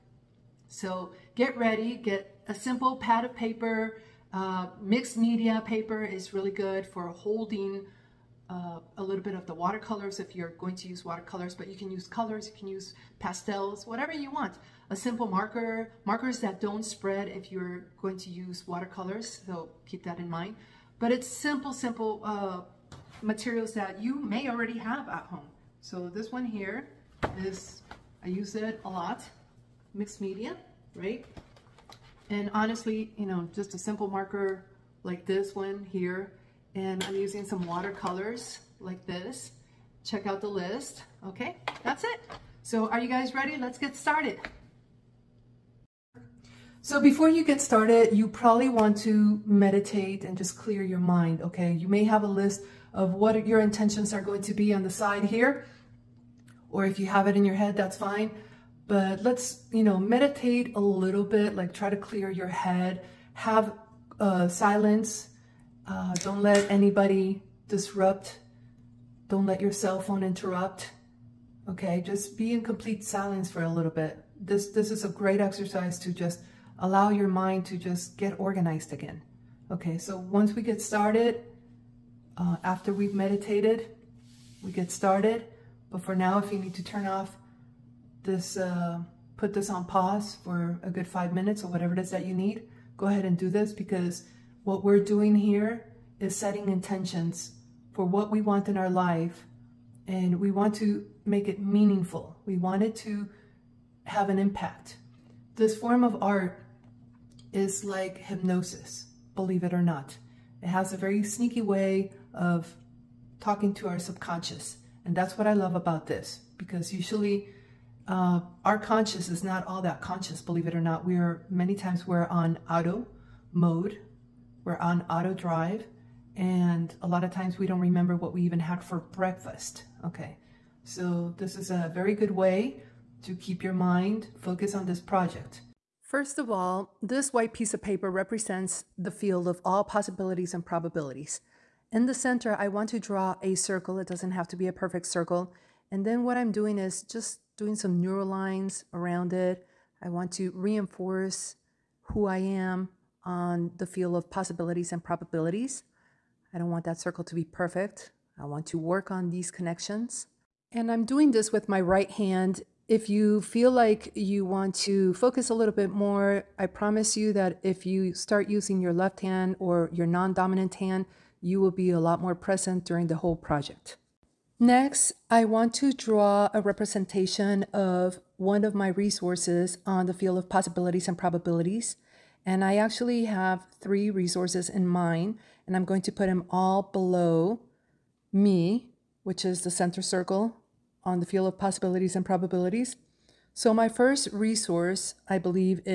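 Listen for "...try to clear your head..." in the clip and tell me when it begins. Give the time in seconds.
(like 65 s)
61 s.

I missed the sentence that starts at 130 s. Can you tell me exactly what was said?
Okay, so this is a very good way to keep your mind focused on this project.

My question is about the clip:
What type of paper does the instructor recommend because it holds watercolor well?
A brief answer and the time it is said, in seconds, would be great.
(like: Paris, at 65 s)
Mixed media paper, at 4 s.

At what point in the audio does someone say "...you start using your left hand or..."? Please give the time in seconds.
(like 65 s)
167 s.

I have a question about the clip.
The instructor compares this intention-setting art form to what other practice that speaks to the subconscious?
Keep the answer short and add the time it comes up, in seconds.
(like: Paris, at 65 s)
Hypnosis, at 108 s.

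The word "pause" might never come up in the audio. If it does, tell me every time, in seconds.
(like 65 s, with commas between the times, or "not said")
89 s.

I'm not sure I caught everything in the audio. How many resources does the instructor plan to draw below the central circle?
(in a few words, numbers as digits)
3.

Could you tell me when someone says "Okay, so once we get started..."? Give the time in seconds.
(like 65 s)
79 s.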